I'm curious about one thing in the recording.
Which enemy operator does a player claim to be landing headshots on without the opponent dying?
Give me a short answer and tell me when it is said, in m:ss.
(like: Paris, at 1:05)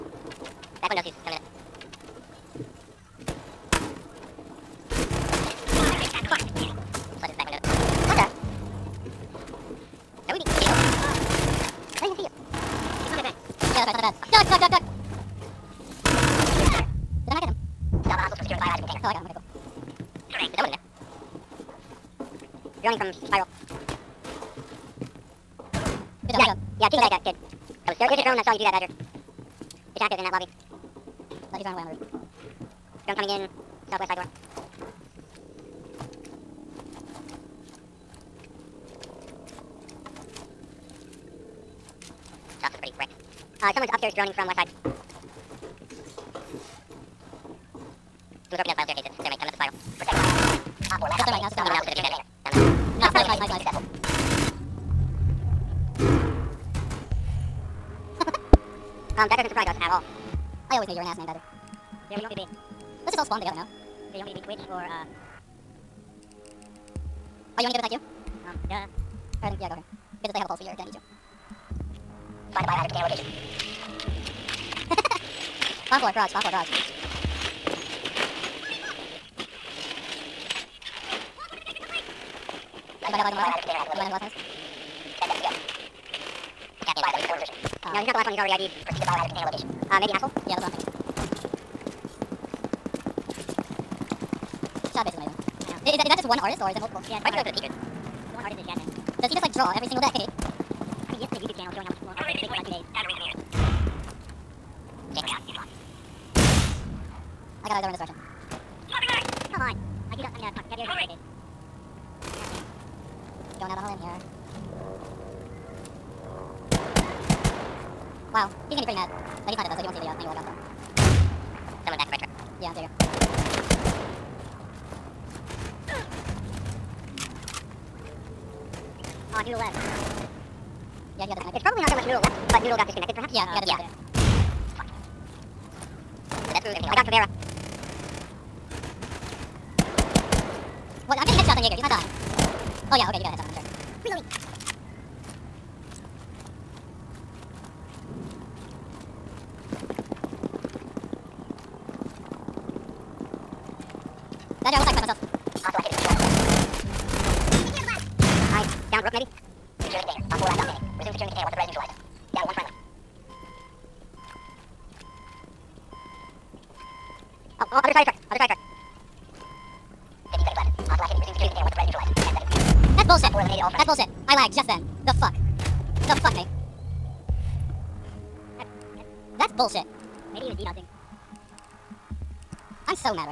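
Jaeger, at 2:21.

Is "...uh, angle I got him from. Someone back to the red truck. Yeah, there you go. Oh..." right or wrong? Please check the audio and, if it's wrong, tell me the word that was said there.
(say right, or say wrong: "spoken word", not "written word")
right.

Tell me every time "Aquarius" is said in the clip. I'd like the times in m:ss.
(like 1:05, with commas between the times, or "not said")
not said.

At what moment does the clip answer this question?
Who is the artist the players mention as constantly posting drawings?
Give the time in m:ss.
1:38.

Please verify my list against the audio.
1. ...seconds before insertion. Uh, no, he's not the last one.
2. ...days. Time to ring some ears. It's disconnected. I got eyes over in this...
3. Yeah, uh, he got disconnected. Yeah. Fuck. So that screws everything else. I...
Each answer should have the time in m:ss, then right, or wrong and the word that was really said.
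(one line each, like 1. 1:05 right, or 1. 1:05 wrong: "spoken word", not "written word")
1. 1:27 right
2. 1:42 wrong: "locked", not "disconnected"
3. 2:13 right.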